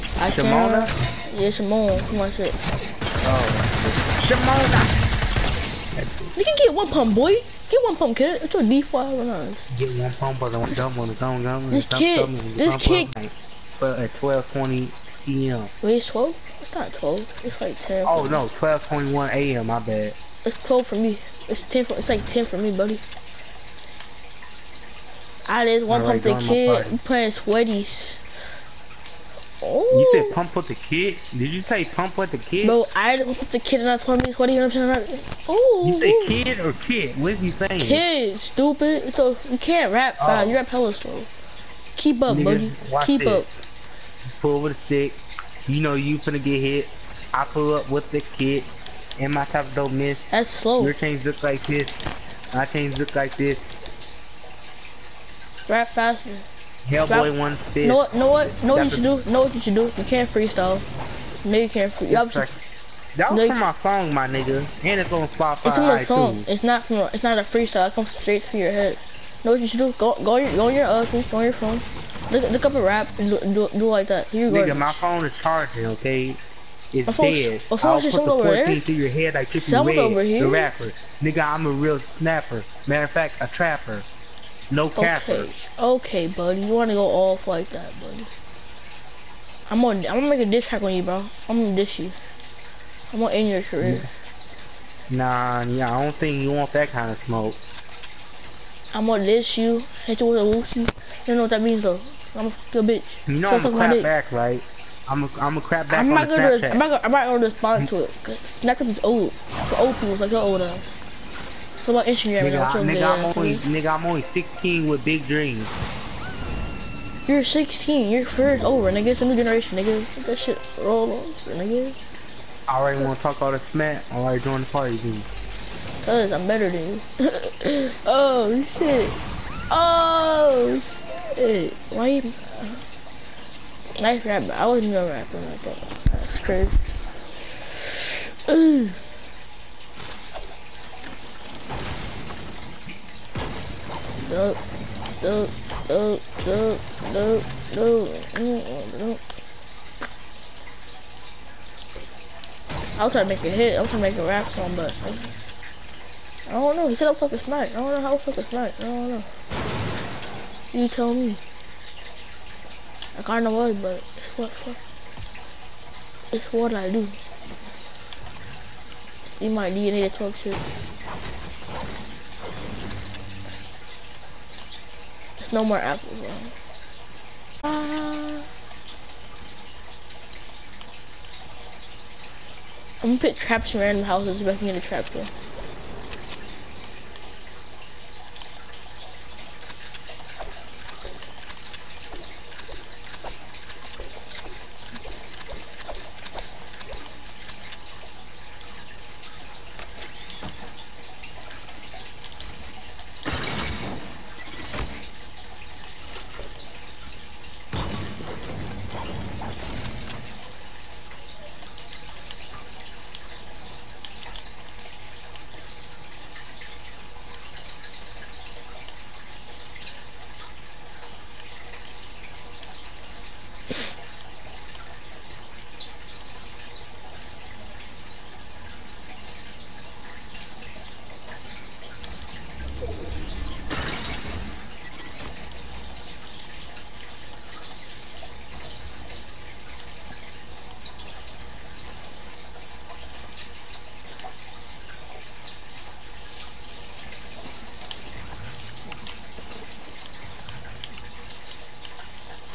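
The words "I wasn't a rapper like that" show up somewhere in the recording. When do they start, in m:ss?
2:14.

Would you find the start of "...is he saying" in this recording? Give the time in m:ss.
0:37.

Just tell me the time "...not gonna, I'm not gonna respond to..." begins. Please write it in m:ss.
1:46.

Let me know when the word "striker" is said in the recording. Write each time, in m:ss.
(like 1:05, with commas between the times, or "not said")
not said.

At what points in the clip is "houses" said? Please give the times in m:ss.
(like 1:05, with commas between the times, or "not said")
3:04.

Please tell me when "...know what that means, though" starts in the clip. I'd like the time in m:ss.
1:41.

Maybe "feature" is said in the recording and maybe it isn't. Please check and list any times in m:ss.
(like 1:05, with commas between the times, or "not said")
not said.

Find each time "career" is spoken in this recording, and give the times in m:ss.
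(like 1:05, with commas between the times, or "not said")
1:33, 1:58.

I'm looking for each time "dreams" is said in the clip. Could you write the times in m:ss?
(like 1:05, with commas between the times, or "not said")
1:55.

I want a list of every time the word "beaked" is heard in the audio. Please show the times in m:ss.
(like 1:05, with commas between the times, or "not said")
not said.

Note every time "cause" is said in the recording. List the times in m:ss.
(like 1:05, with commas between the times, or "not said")
1:48, 2:06.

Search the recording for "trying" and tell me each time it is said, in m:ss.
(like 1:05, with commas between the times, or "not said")
2:33.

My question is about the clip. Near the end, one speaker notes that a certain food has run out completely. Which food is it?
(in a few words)
apples.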